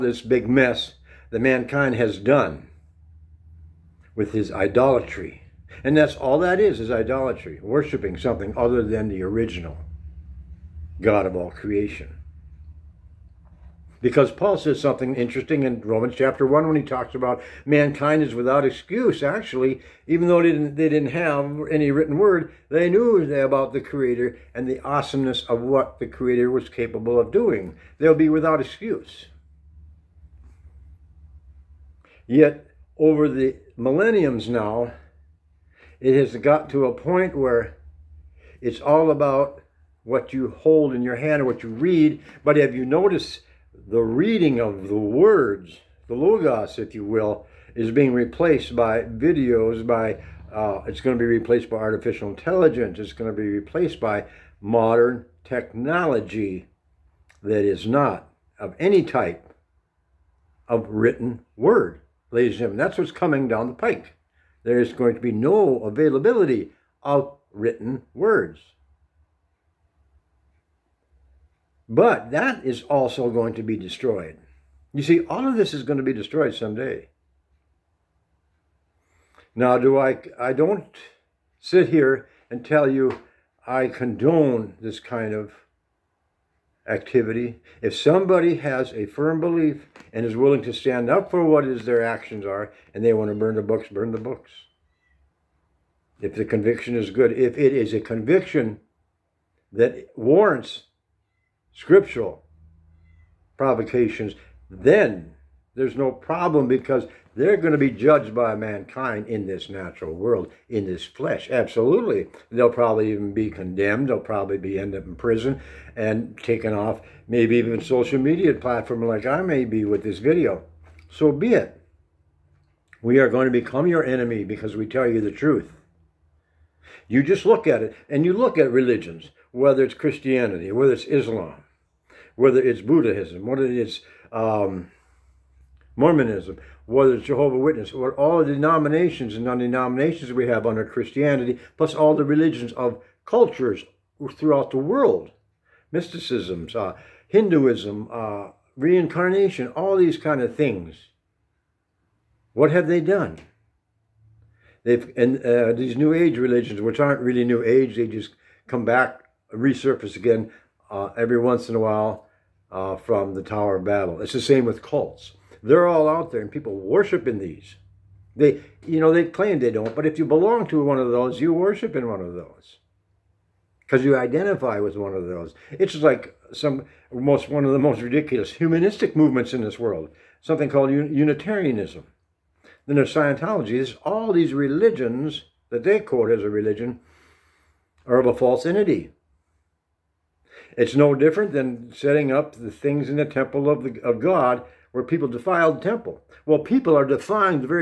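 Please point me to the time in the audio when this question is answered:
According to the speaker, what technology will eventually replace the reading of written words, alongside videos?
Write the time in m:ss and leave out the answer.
0:51.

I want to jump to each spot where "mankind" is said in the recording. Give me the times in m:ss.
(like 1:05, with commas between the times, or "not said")
0:01, 0:17, 1:48.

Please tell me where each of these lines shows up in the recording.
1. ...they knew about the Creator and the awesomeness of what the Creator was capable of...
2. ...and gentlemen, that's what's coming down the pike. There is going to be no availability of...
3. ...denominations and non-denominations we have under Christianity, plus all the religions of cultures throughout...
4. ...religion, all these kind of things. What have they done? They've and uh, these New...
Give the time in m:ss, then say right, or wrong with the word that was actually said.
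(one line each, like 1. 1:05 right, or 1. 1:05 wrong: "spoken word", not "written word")
1. 0:22 right
2. 1:02 right
3. 2:18 right
4. 2:28 wrong: "reincarnation", not "religion".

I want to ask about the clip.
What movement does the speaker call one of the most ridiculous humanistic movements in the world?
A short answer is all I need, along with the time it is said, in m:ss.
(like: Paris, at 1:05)
Unitarianism, at 3:00.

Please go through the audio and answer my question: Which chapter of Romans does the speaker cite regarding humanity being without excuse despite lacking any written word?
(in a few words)
Chapter 1.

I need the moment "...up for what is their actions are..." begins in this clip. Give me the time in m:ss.
1:31.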